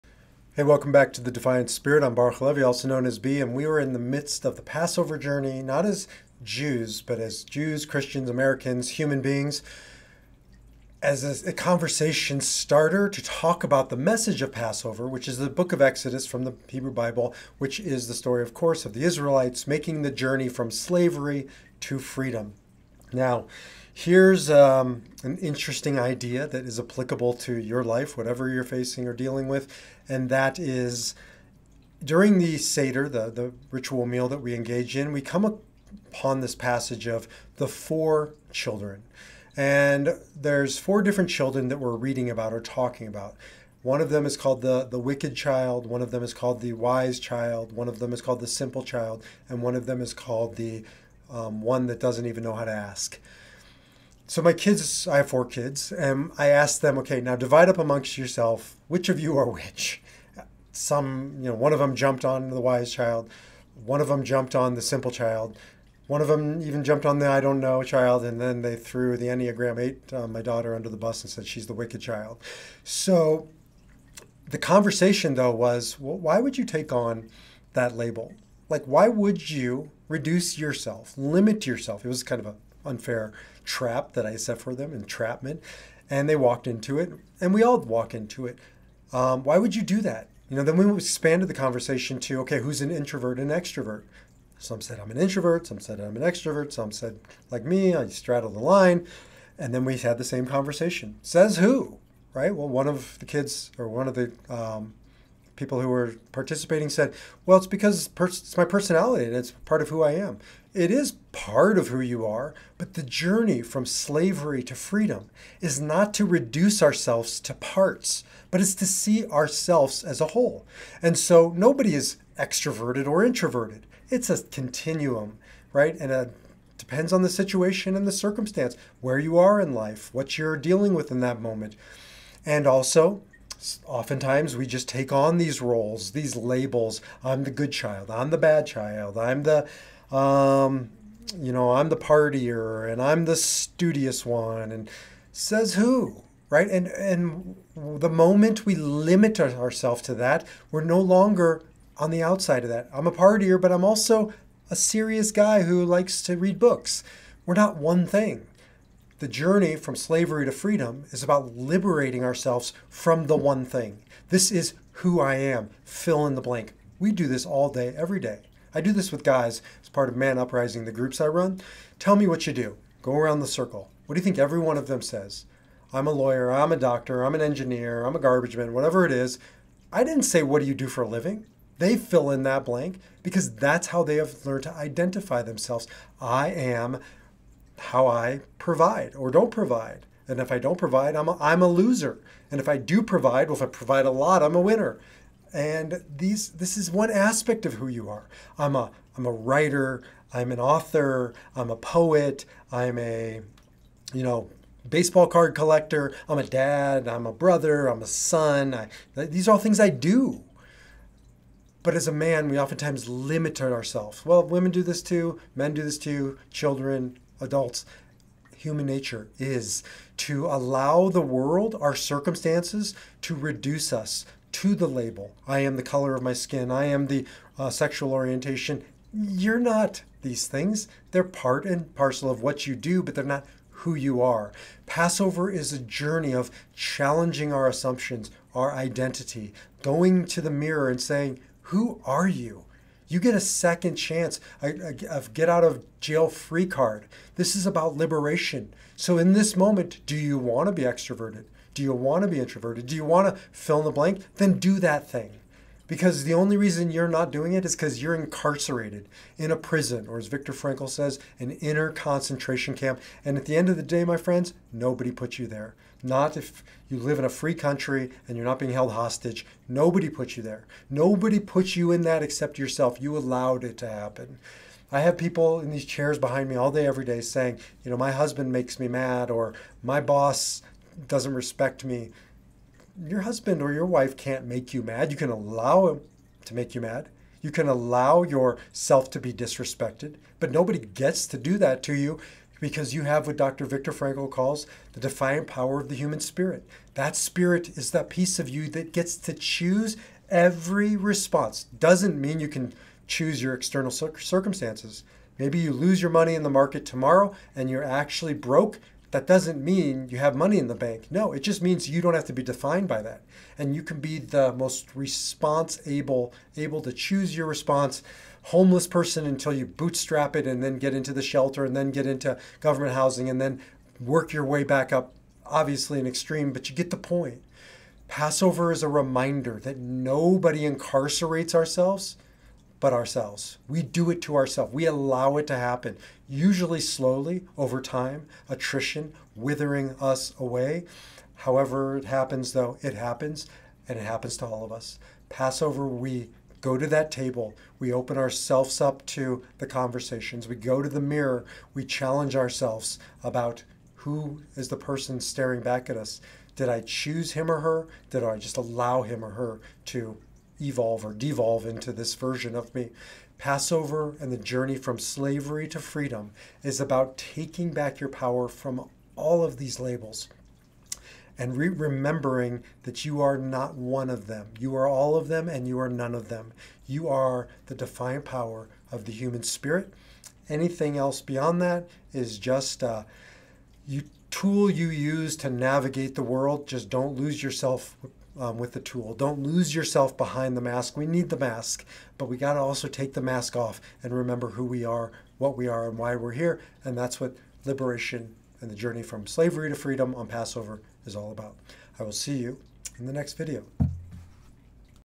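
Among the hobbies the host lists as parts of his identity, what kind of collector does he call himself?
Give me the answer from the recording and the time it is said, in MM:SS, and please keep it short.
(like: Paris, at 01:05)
baseball card collector, at 03:24.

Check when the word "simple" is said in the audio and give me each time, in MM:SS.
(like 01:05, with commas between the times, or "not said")
00:48, 01:04.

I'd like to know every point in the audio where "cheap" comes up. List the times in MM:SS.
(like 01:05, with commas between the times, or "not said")
not said.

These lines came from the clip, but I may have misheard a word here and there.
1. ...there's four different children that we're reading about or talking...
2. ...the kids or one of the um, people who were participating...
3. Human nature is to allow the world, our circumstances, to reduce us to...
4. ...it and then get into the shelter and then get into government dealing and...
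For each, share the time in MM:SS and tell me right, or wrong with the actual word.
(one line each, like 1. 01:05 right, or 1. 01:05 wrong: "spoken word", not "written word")
1. 00:40 right
2. 01:43 right
3. 03:38 right
4. 05:20 wrong: "housing", not "dealing".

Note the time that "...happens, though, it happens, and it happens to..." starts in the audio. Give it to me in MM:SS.
05:42.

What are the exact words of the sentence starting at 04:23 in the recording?
And at the end of the day, my friends, nobody put you there.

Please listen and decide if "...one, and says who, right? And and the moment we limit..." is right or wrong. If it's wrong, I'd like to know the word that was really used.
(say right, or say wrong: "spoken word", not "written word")
right.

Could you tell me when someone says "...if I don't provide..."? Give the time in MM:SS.
03:10.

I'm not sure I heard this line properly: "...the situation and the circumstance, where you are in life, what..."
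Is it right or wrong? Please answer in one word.
right.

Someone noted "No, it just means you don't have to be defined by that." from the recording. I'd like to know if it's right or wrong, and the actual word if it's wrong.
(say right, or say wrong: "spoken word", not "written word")
right.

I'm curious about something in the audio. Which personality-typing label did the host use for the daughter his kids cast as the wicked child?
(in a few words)
Enneagram 8.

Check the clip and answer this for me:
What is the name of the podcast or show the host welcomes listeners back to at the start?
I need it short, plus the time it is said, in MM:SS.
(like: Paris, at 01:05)
The Defiant Spirit, at 00:01.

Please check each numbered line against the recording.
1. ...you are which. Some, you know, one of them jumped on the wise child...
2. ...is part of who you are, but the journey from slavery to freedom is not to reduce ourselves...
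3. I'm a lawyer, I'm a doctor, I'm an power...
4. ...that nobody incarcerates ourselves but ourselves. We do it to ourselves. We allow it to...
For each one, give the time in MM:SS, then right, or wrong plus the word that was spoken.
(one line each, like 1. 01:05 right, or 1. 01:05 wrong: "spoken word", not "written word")
1. 00:59 right
2. 01:50 right
3. 02:55 wrong: "engineer", not "power"
4. 05:29 right.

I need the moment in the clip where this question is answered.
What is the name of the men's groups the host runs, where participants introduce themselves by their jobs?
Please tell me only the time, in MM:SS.
02:50.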